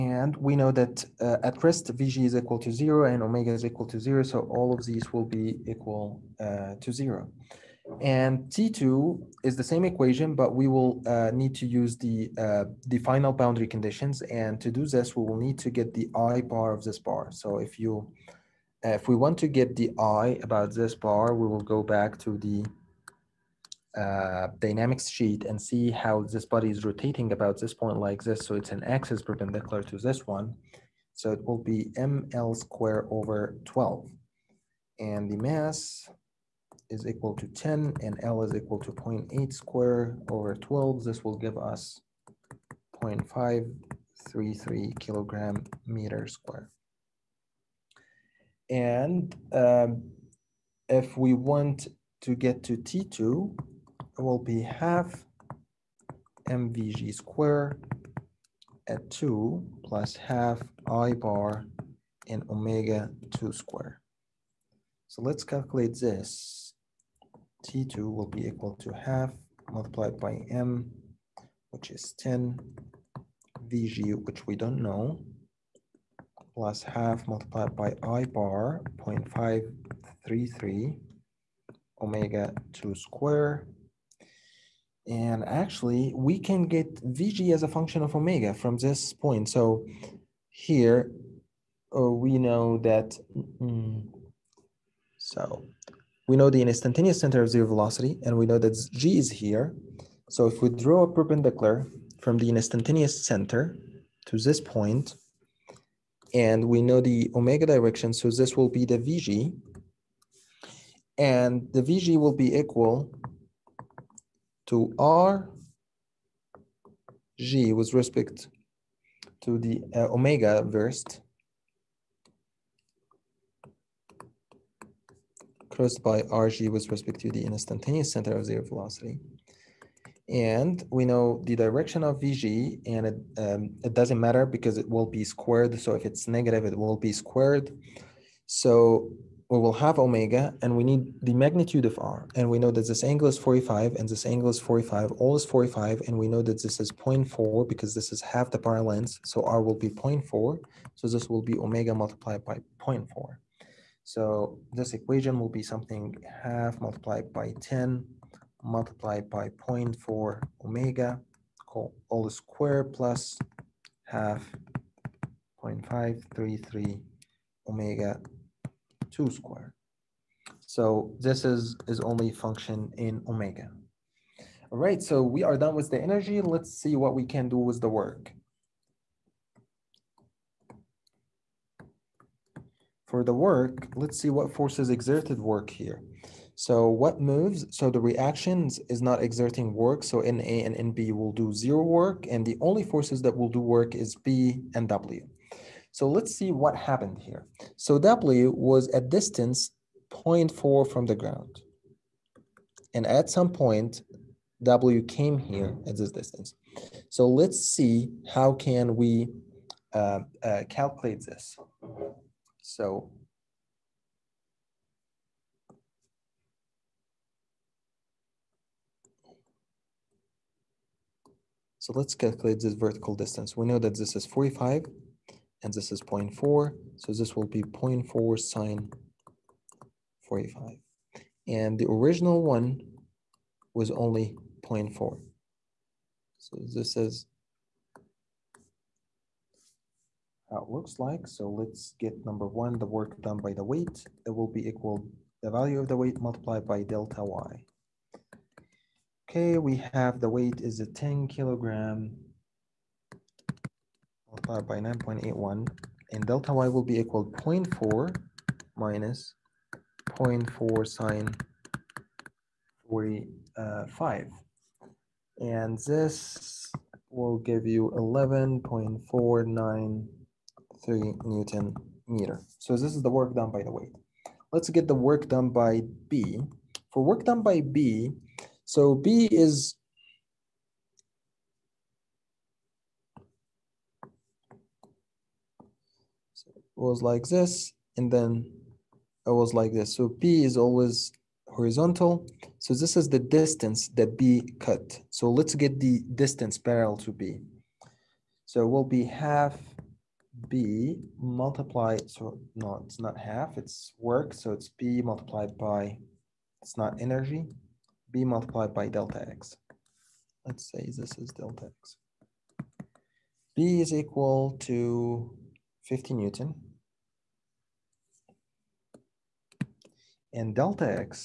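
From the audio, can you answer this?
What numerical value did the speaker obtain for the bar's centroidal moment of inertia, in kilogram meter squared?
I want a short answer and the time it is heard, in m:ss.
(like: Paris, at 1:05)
0.533, at 0:43.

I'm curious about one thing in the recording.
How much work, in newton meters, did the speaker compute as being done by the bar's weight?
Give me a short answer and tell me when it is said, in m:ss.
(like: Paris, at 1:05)
11.493, at 4:27.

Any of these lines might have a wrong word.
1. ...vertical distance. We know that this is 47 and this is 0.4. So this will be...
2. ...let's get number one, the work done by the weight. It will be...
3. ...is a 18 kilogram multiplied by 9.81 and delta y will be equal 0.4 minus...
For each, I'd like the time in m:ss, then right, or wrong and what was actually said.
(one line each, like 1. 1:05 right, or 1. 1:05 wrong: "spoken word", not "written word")
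1. 3:42 wrong: "45", not "47"
2. 4:01 right
3. 4:10 wrong: "10", not "18".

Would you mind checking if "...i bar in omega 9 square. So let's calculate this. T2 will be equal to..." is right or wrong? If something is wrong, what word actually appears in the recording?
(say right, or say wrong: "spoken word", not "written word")
wrong: "2", not "9".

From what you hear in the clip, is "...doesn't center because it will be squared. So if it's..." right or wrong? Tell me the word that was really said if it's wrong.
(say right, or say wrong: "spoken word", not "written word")
wrong: "matter", not "center".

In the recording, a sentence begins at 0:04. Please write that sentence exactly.
So all of these will be equal uh, to zero.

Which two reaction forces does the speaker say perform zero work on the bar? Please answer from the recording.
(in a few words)
NA and NB.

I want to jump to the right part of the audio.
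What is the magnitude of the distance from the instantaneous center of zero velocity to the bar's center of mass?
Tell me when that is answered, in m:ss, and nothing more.
2:29.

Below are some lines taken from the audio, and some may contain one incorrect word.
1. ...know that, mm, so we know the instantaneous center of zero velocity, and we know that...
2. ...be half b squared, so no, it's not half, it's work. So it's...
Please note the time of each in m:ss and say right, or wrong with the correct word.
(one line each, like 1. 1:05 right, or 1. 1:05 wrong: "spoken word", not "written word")
1. 1:32 right
2. 4:58 wrong: "multiplied", not "squared".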